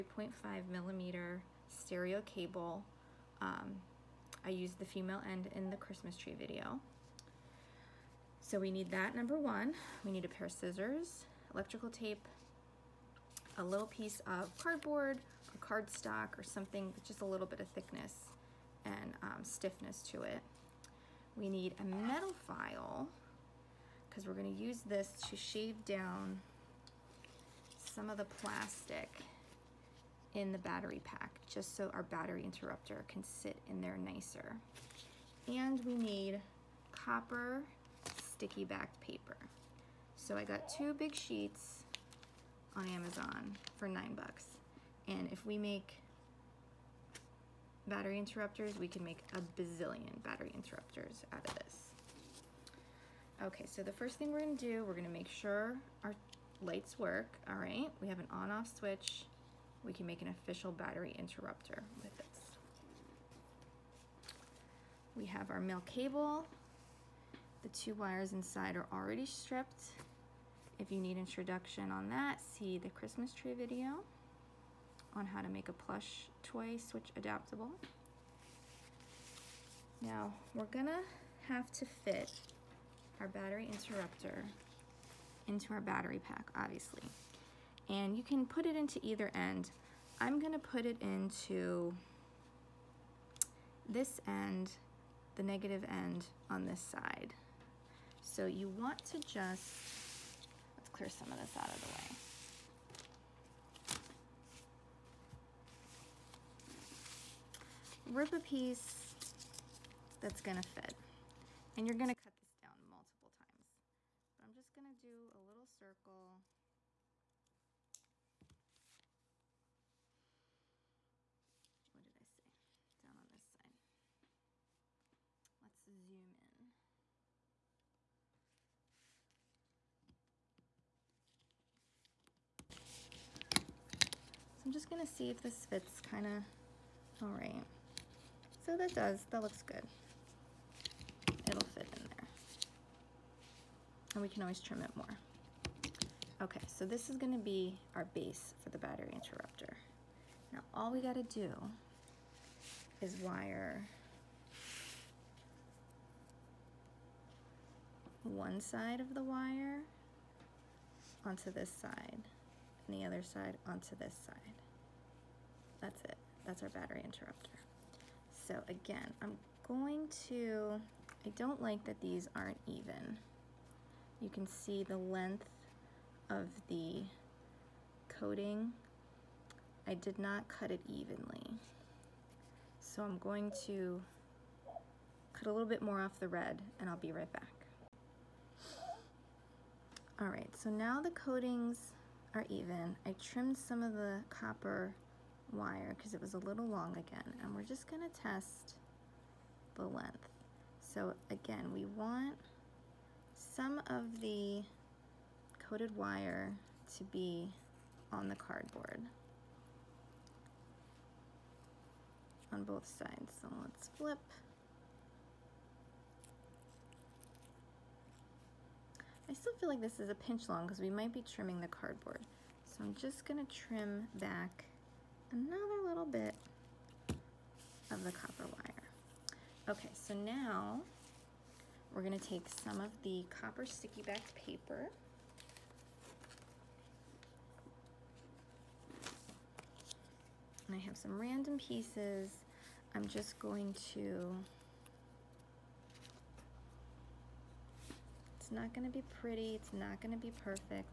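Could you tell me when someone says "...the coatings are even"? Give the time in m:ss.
3:10.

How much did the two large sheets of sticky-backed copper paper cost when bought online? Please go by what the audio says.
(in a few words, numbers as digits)
$9.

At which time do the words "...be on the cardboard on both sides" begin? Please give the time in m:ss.
3:27.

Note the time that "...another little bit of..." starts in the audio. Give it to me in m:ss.
3:45.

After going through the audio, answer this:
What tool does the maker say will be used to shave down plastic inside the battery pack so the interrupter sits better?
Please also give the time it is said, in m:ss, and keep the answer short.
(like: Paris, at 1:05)
Metal file, at 0:21.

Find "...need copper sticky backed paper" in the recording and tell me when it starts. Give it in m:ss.
0:35.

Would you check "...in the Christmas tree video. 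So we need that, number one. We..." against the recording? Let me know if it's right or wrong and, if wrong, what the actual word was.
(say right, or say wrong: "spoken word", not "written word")
right.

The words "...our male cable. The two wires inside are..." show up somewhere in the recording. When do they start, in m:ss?
1:05.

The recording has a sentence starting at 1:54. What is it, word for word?
But I'm just gonna do a little circle.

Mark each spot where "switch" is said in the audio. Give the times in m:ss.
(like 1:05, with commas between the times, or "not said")
0:58, 1:16.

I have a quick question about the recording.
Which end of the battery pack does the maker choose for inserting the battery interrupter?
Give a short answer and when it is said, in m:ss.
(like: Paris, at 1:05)
Negative end, at 1:35.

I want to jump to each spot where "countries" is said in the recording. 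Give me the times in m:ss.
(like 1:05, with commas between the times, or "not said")
not said.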